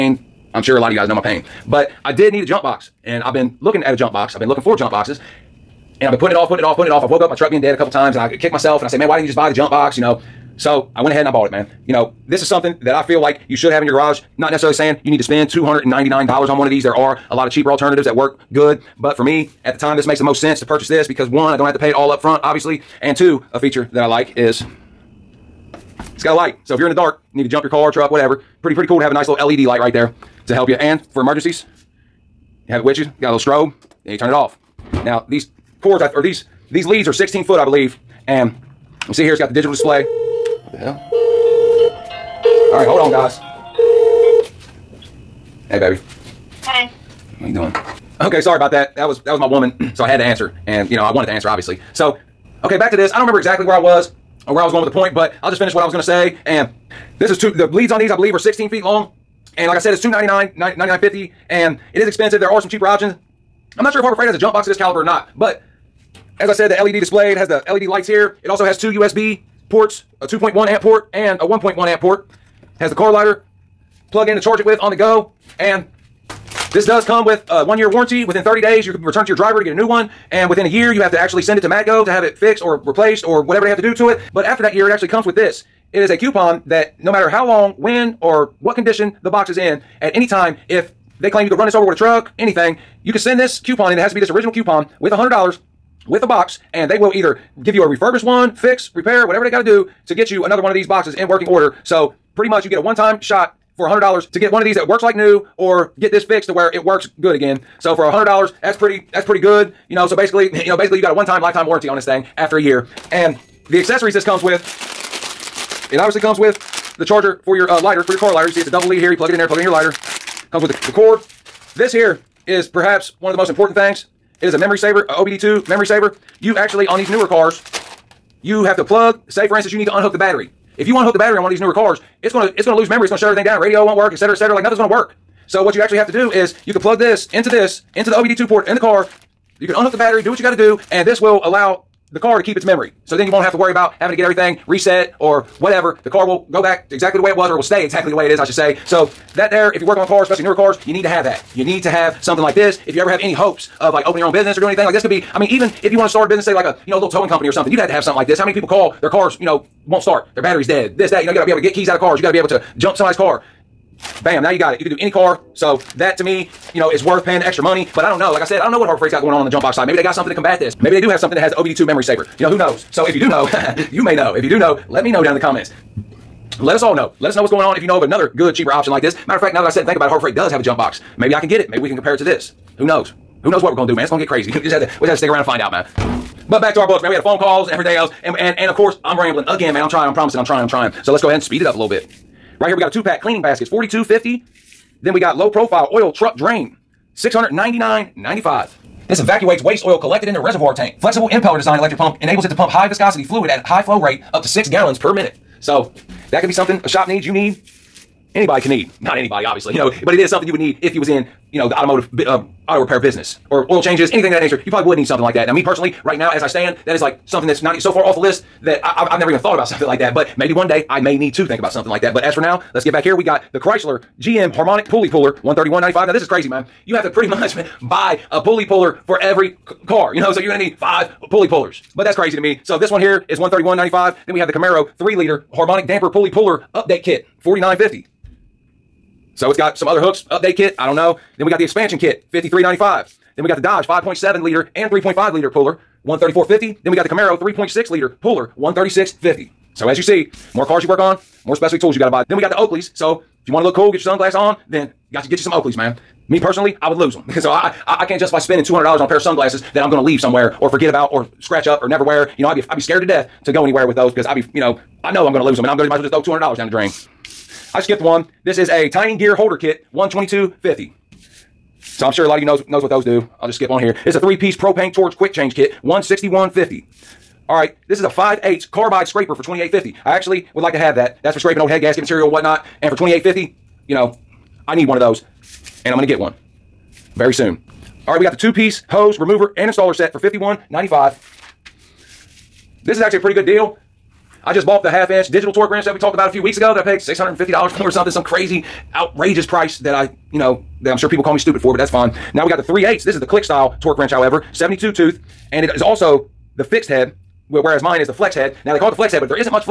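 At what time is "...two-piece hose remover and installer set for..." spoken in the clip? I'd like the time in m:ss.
4:48.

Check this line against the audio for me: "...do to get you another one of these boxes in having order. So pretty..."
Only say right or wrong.
wrong.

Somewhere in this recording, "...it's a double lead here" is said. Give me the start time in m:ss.
1:58.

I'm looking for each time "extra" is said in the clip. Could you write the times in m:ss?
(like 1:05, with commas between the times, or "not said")
2:47.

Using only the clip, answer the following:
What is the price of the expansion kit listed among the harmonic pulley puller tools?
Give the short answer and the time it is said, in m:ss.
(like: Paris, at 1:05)
$53.95, at 4:02.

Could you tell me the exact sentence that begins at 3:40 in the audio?
But maybe one day I may need to think about something like that.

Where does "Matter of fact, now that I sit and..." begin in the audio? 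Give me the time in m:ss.
2:59.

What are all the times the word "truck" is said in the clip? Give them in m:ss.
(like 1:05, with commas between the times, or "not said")
0:07, 0:27, 1:31, 3:16.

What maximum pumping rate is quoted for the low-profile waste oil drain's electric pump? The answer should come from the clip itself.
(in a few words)
6 gallons per minute.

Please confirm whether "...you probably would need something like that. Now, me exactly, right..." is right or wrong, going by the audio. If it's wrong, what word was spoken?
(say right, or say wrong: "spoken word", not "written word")
wrong: "personally", not "exactly".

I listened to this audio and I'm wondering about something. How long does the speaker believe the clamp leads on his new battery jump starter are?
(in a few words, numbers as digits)
16 feet.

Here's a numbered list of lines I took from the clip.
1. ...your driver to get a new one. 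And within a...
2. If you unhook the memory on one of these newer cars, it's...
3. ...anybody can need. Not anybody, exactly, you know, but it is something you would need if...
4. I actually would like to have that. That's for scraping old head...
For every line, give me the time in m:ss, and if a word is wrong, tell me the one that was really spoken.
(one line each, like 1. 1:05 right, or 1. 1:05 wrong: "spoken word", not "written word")
1. 1:19 right
2. 2:10 wrong: "battery", not "memory"
3. 3:28 wrong: "obviously", not "exactly"
4. 4:40 right.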